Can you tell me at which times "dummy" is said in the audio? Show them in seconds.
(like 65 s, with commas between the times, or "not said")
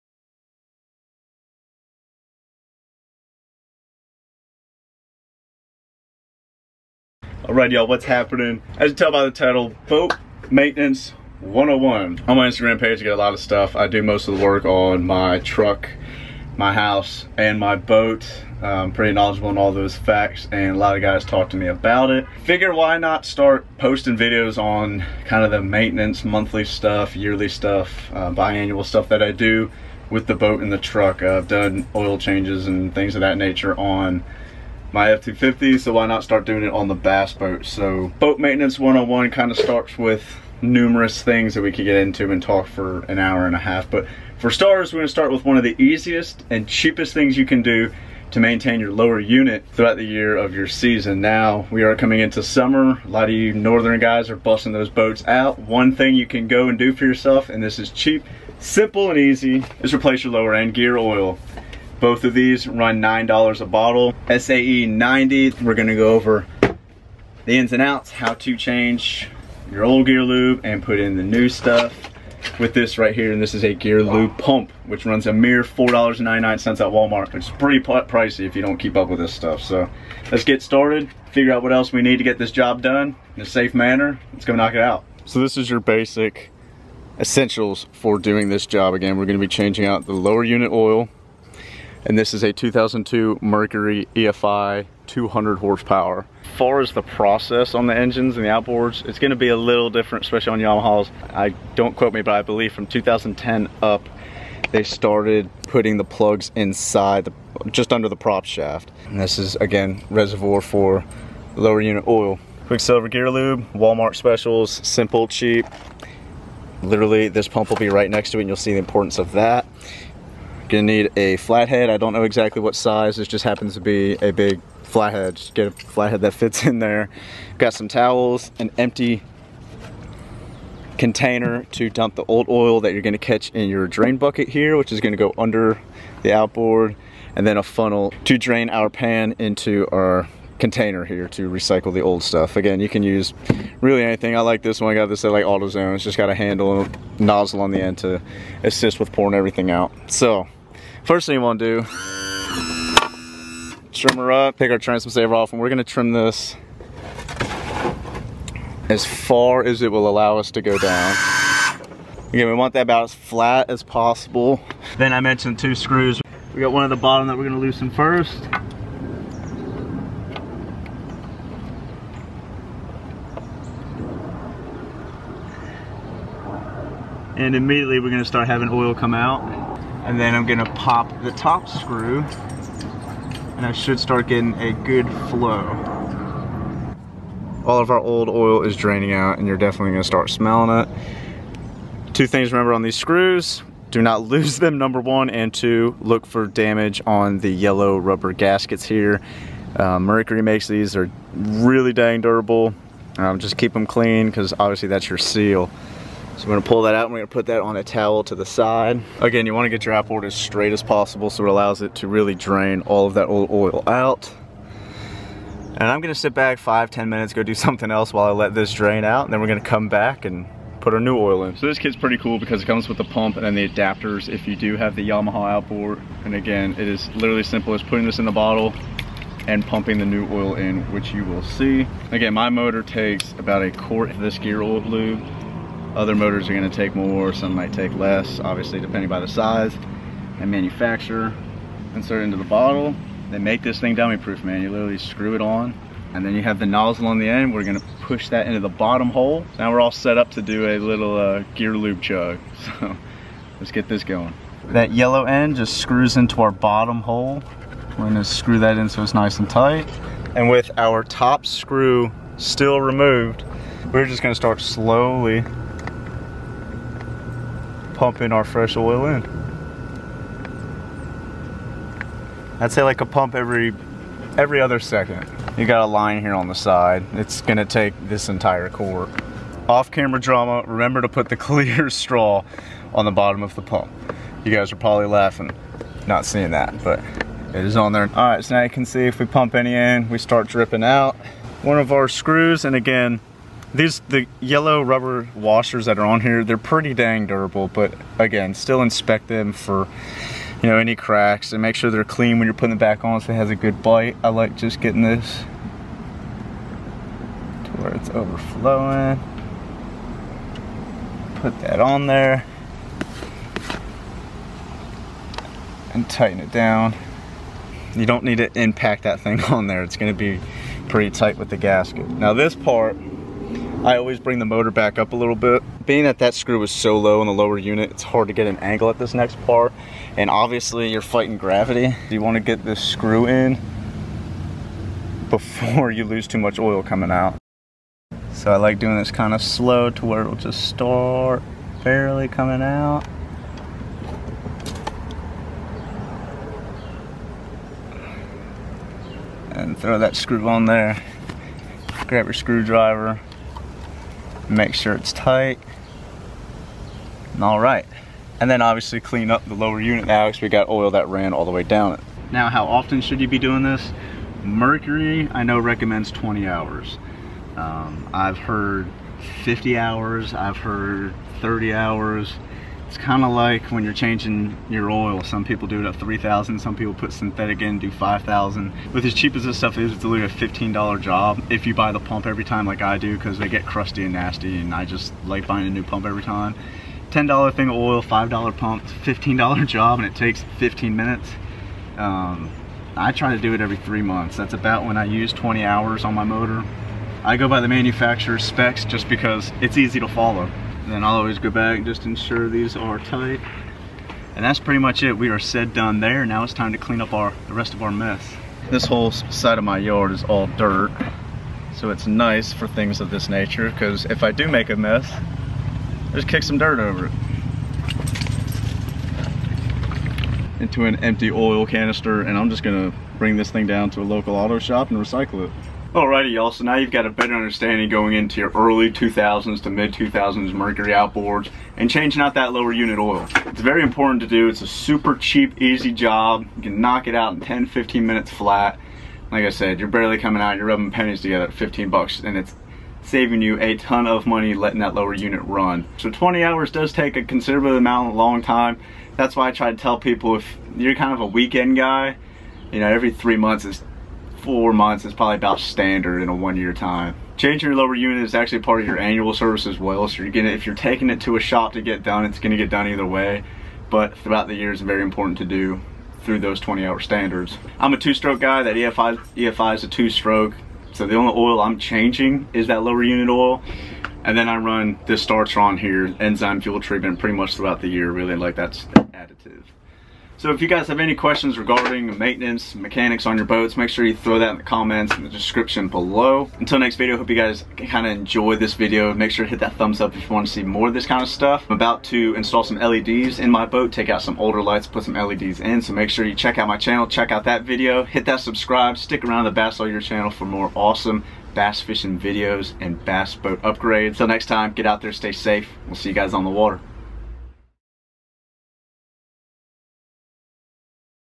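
243 s.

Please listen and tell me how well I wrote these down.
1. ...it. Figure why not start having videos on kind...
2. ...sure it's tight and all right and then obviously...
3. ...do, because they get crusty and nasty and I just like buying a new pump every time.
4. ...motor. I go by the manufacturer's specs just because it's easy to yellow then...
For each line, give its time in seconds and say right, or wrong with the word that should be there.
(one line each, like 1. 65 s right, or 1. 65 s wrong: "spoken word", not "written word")
1. 22 s wrong: "posting", not "having"
2. 354 s right
3. 382 s right
4. 396 s wrong: "follow", not "yellow".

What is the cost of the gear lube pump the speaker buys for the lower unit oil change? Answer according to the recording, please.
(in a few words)
$4.99.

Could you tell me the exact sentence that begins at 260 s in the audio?
And with our top screw still removed, we're just gonna start slowly pumping our fresh oil in.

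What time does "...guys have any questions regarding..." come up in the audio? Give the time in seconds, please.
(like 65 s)
480 s.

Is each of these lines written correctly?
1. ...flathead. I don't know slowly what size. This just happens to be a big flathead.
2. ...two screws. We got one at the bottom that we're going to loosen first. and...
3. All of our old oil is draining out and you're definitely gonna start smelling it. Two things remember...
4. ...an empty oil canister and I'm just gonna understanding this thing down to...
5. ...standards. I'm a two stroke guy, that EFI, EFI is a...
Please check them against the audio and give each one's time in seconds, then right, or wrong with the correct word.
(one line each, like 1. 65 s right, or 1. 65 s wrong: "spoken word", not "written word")
1. 121 s wrong: "exactly", not "slowly"
2. 165 s right
3. 187 s right
4. 420 s wrong: "bring", not "understanding"
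5. 466 s right.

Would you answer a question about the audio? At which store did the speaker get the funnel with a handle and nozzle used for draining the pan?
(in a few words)
AutoZone.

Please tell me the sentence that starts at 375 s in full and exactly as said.
Some people do it at 3,000, some people put synthetic in, do 5,000.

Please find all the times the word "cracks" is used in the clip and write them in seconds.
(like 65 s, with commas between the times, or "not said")
300 s.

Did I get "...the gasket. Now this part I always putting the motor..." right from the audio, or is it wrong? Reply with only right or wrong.
wrong.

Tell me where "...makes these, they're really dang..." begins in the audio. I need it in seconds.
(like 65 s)
200 s.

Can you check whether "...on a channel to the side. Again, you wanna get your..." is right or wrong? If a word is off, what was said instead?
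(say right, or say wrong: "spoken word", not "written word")
wrong: "towel", not "channel".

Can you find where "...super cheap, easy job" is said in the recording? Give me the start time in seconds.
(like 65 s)
434 s.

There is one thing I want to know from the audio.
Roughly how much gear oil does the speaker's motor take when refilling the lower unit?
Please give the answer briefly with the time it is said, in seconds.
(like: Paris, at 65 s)
A quart, at 233 s.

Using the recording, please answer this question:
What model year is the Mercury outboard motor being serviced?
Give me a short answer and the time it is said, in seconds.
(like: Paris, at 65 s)
2002, at 92 s.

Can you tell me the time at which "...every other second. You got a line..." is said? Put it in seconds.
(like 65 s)
274 s.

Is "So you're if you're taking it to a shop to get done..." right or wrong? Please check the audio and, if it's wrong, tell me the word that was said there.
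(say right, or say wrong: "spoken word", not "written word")
right.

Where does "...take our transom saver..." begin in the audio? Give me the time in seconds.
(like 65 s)
154 s.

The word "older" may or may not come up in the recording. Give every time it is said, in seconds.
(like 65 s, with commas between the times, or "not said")
494 s.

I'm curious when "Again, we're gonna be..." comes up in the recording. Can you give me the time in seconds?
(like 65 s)
88 s.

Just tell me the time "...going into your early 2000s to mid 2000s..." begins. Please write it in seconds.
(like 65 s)
427 s.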